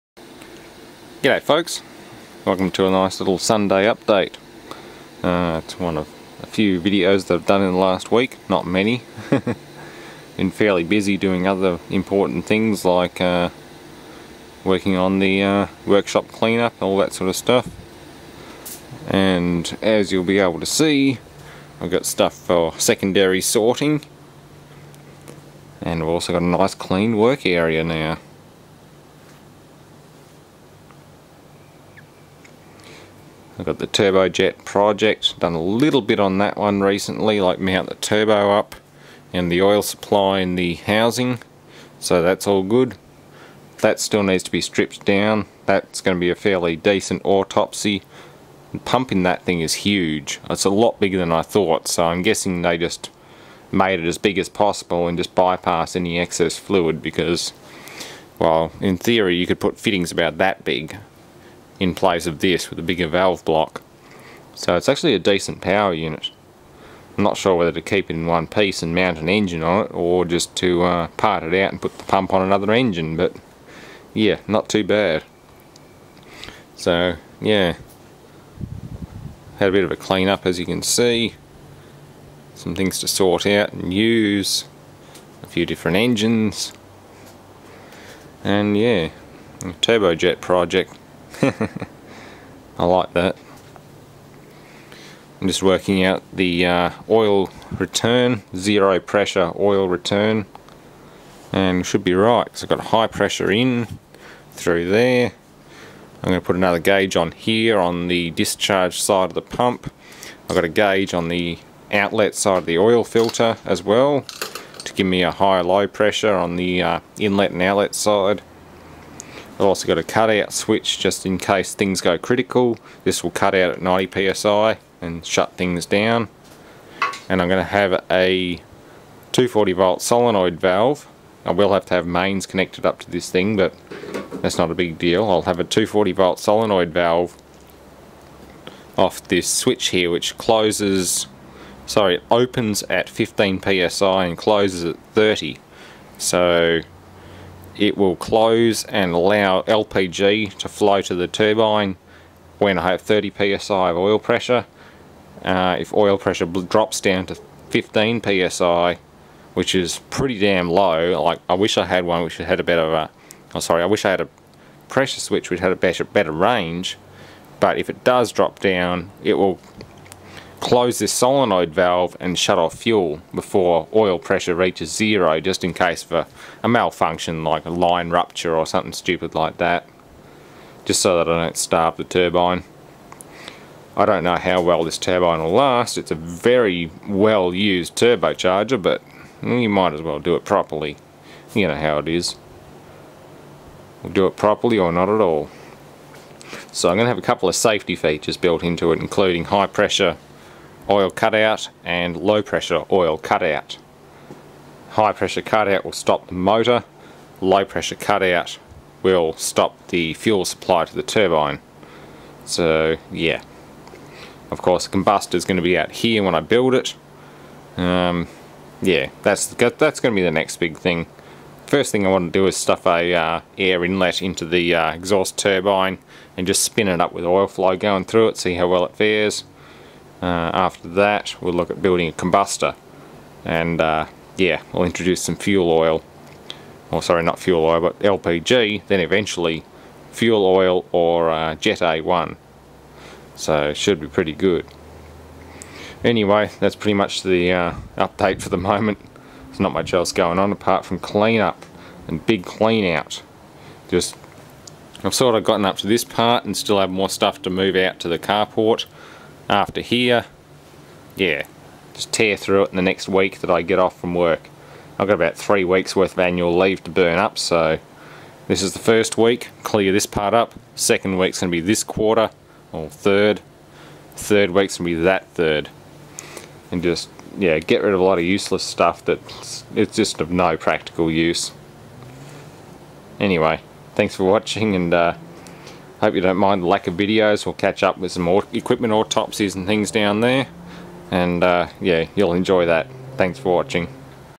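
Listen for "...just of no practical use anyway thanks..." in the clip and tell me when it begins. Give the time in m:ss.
4:39.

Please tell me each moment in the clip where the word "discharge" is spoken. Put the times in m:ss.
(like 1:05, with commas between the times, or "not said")
1:48.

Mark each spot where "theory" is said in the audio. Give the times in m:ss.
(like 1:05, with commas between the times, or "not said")
0:58.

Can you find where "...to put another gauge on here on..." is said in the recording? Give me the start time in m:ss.
1:46.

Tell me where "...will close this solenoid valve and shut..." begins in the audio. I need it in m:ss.
2:49.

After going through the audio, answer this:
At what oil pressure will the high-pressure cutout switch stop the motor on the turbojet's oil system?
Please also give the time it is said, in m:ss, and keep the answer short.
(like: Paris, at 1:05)
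90 psi, at 2:03.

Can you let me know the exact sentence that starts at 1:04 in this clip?
So it's actually a decent power unit.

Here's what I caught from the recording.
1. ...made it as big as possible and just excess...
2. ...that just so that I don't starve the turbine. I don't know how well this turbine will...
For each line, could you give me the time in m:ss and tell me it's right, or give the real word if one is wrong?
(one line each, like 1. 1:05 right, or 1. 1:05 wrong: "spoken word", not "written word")
1. 0:53 wrong: "bypass", not "excess"
2. 2:59 right.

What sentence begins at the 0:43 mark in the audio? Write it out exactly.
That still needs to be stripped down, that's going to be a fairly decent autopsy.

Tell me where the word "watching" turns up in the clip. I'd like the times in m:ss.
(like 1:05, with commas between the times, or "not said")
4:44, 4:53.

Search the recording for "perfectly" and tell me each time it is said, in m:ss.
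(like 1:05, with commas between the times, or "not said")
not said.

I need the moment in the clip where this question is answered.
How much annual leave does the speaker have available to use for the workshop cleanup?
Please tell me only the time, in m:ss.
4:25.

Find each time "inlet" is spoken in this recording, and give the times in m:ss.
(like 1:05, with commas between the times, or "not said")
1:57, 3:43.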